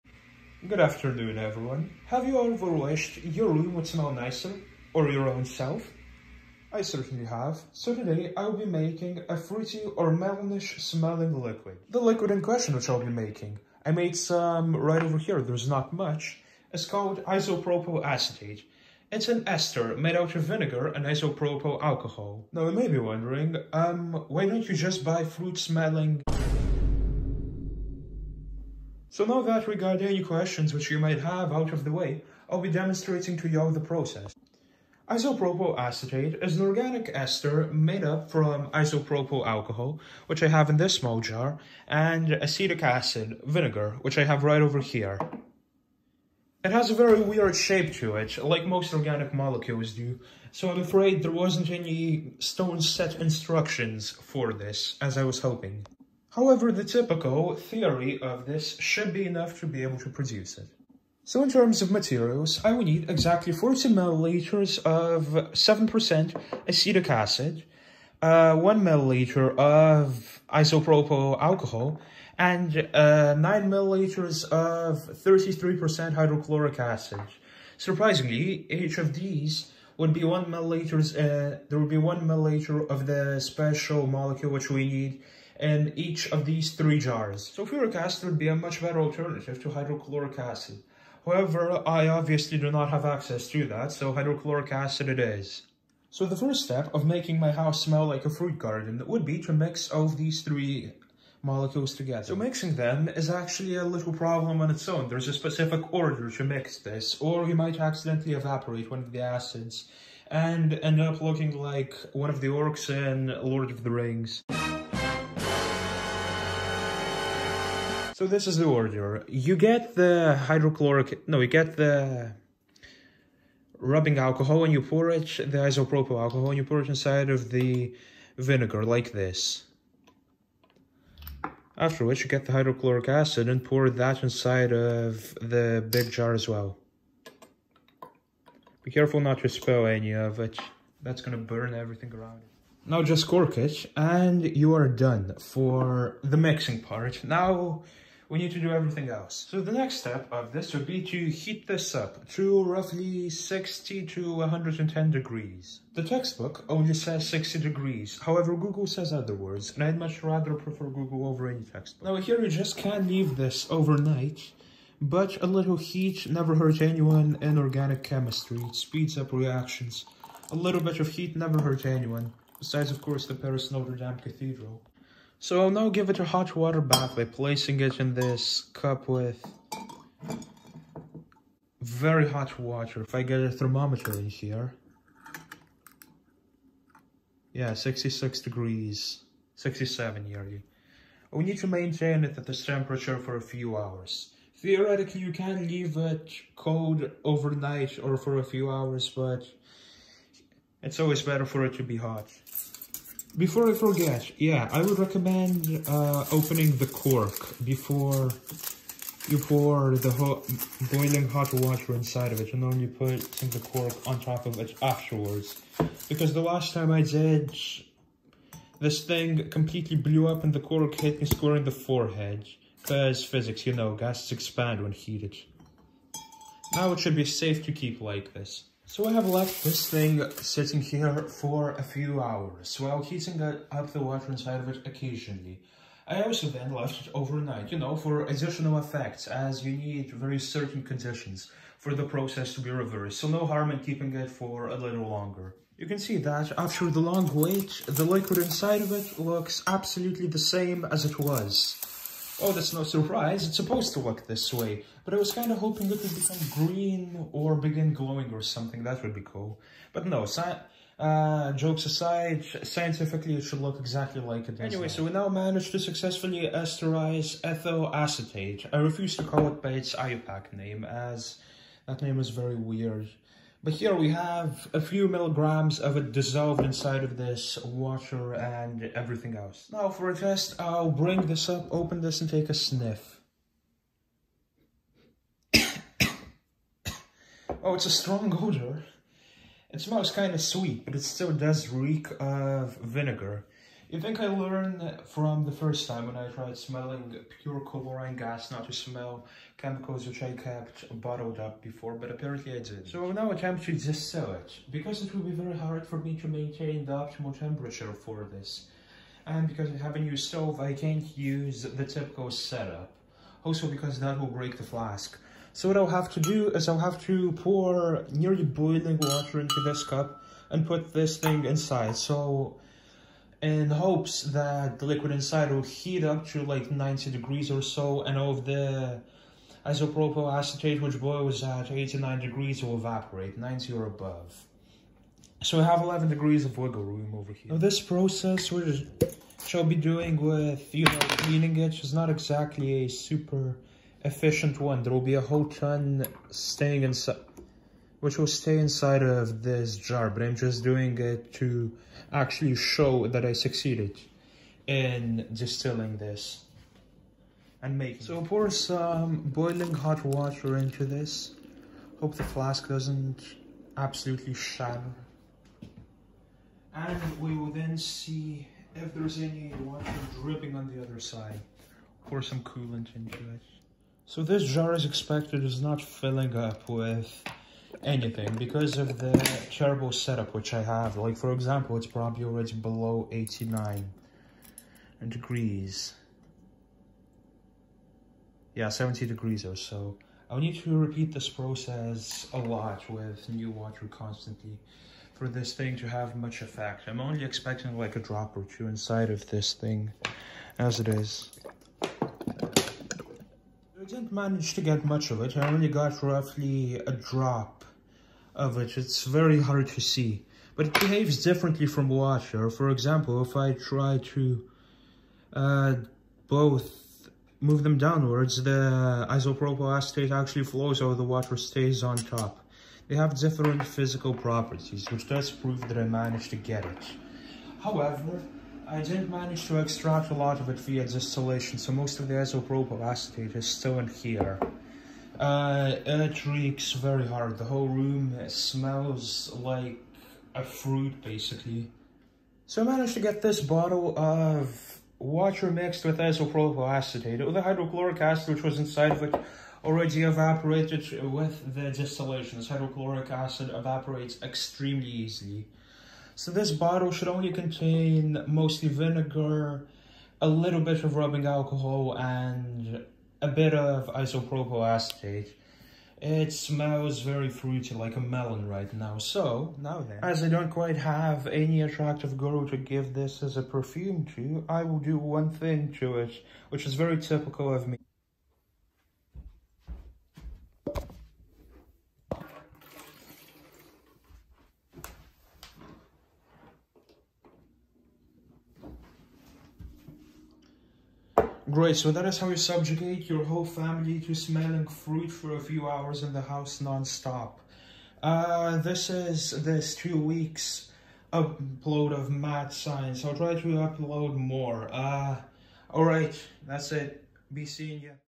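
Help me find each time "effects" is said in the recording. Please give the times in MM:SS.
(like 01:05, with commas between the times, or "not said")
03:58, 06:36.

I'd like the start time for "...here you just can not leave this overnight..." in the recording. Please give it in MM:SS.
02:42.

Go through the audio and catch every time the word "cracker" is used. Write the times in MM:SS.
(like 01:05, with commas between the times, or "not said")
not said.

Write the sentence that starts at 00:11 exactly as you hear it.
The liquid in question which I'll be making, I made some right over here, there's not much, is called isopropyl acetate.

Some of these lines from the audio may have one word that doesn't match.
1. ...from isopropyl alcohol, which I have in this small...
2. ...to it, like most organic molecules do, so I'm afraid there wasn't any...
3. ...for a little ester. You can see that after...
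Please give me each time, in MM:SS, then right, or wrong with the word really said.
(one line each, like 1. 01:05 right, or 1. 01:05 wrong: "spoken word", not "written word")
1. 00:38 right
2. 00:48 right
3. 04:04 wrong: "longer", not "ester".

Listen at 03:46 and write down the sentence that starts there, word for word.
Now it should be safe to keep like this.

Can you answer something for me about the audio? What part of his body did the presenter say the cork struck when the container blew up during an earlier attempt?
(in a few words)
Forehead.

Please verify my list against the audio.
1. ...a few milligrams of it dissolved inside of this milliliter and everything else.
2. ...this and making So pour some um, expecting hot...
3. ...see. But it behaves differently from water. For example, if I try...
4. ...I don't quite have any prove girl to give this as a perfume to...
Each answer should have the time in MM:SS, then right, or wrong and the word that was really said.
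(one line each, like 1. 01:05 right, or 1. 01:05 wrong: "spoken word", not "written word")
1. 04:34 wrong: "water", not "milliliter"
2. 05:55 wrong: "boiling", not "expecting"
3. 06:49 right
4. 07:50 wrong: "attractive", not "prove".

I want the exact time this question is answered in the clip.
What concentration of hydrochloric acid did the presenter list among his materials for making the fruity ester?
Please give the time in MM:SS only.
01:15.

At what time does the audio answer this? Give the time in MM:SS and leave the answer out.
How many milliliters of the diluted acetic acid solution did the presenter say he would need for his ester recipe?
01:03.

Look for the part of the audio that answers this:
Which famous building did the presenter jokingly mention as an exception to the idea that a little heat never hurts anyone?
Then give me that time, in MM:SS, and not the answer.
02:53.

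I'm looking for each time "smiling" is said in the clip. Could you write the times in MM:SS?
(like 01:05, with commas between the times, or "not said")
not said.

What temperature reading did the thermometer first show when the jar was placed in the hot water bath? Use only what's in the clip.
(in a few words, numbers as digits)
66 degrees.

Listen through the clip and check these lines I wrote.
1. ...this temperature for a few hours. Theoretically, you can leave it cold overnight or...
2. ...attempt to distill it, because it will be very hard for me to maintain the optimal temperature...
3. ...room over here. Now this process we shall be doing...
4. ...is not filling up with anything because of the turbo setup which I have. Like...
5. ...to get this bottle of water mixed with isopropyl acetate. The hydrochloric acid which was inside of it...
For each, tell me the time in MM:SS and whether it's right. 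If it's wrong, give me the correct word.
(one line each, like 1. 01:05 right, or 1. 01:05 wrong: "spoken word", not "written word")
1. 03:12 right
2. 05:03 right
3. 05:36 right
4. 06:15 right
5. 07:22 right.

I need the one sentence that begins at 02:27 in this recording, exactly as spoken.
Now we need to do everything else.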